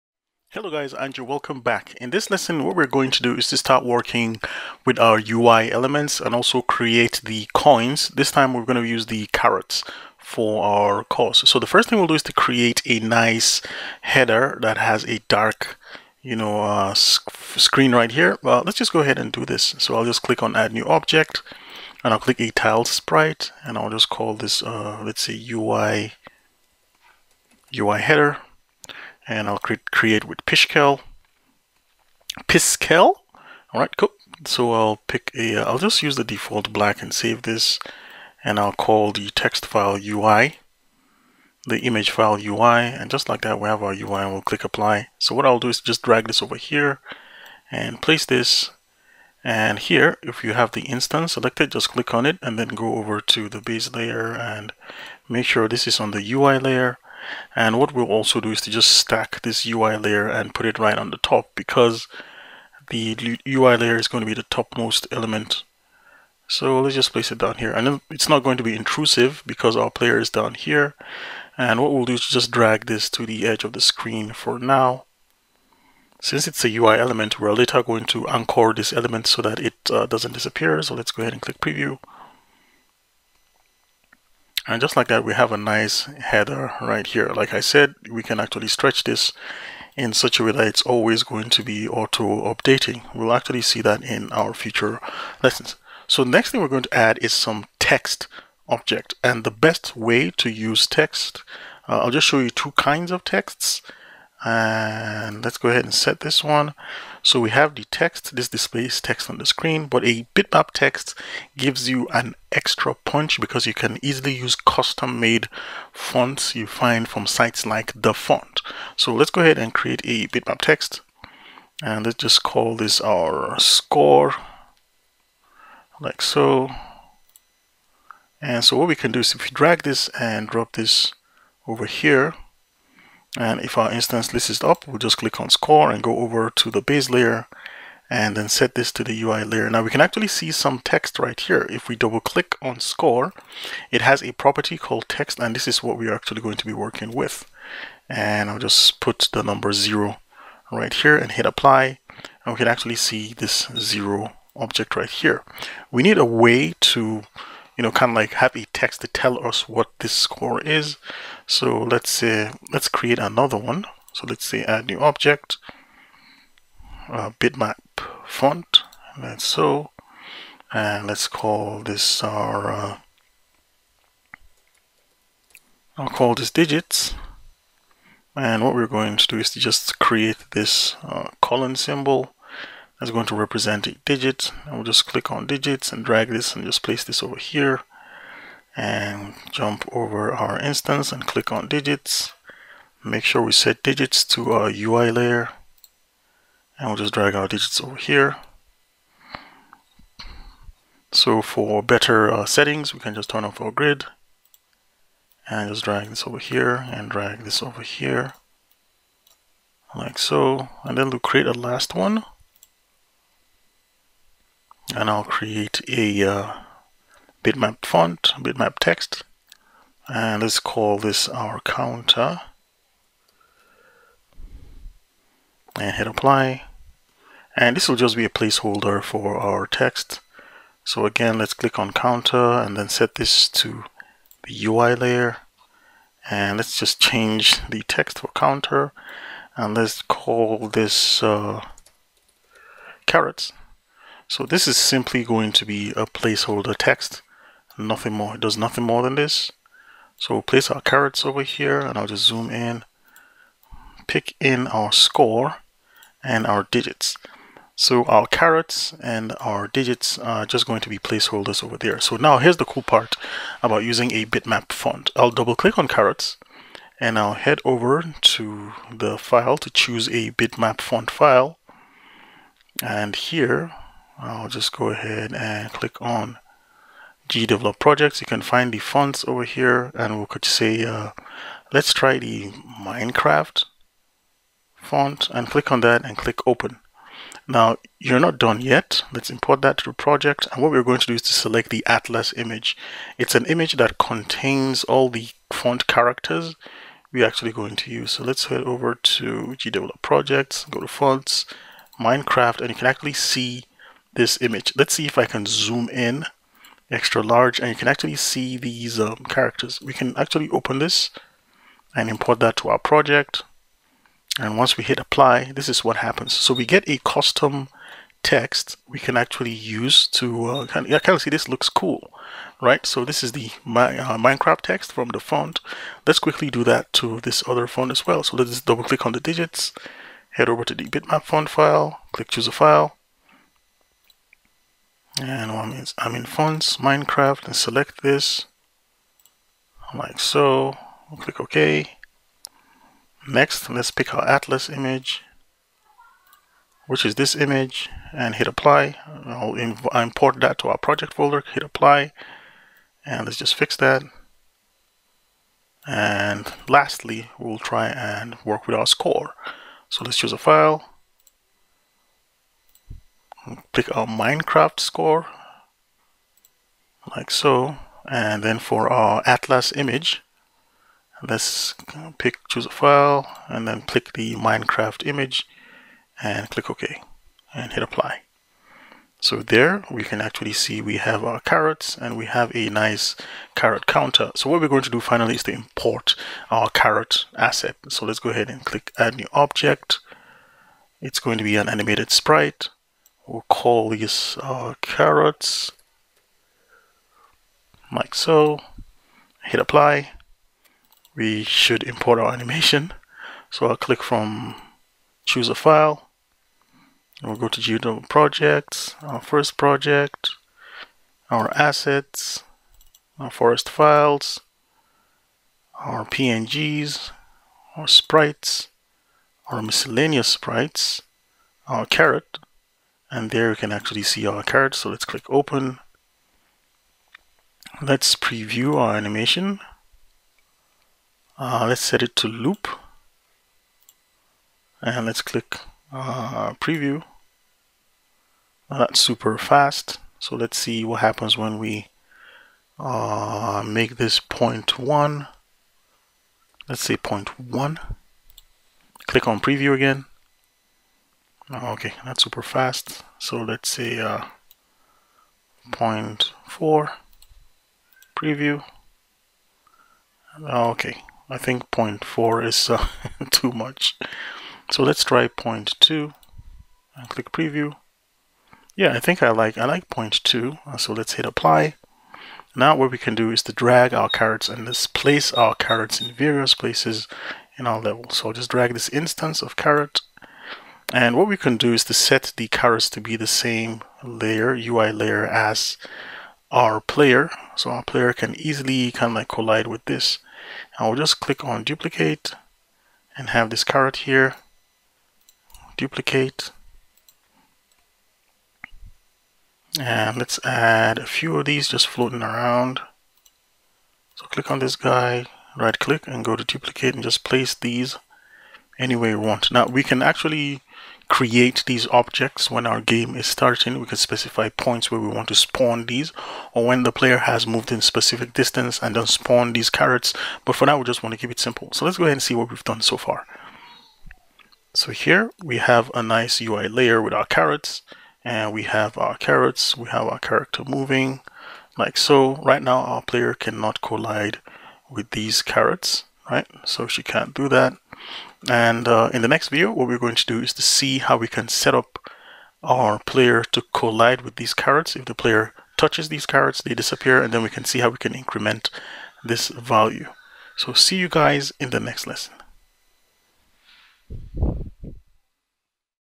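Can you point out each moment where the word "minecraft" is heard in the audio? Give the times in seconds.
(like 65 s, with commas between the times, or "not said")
282 s, 301 s, 324 s, 336 s, 364 s, 374 s.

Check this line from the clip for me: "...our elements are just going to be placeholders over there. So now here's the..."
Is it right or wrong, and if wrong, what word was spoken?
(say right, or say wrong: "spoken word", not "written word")
wrong: "digits", not "elements".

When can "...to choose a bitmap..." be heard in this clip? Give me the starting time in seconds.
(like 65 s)
269 s.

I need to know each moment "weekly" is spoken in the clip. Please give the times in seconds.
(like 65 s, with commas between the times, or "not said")
not said.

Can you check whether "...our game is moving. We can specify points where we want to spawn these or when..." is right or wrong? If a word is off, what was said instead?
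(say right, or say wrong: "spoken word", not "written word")
wrong: "starting", not "moving".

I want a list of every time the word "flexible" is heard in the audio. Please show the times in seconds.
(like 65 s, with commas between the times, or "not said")
not said.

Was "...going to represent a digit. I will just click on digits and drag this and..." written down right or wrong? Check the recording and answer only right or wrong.
right.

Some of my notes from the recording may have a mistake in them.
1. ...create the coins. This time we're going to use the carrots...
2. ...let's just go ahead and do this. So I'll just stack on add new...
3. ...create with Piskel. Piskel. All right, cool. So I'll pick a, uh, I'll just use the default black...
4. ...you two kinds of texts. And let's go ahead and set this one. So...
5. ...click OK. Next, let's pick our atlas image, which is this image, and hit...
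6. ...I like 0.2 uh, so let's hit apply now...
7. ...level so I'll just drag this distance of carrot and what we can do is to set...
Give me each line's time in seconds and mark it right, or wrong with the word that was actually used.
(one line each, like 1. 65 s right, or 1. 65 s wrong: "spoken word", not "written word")
1. 6 s right
2. 18 s wrong: "click", not "stack"
3. 29 s right
4. 102 s right
5. 341 s right
6. 469 s right
7. 477 s wrong: "instance", not "distance".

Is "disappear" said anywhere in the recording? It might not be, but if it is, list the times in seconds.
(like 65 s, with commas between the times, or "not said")
80 s, 546 s.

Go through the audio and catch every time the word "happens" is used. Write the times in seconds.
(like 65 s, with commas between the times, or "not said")
315 s, 441 s.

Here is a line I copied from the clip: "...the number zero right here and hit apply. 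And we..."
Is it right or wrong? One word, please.
right.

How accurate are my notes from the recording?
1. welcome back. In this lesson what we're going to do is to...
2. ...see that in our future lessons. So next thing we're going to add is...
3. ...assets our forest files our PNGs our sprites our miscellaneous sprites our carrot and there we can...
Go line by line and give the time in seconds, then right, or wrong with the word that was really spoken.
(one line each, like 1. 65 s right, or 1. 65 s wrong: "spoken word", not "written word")
1. 1 s right
2. 93 s right
3. 411 s right.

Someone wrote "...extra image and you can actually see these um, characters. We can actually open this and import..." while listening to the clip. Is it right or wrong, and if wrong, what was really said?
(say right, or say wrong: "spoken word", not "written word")
wrong: "large", not "image".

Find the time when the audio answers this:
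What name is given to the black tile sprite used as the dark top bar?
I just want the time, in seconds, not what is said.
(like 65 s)
25 s.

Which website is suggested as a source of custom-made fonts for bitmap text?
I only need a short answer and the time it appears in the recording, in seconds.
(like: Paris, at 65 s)
DaFont, at 117 s.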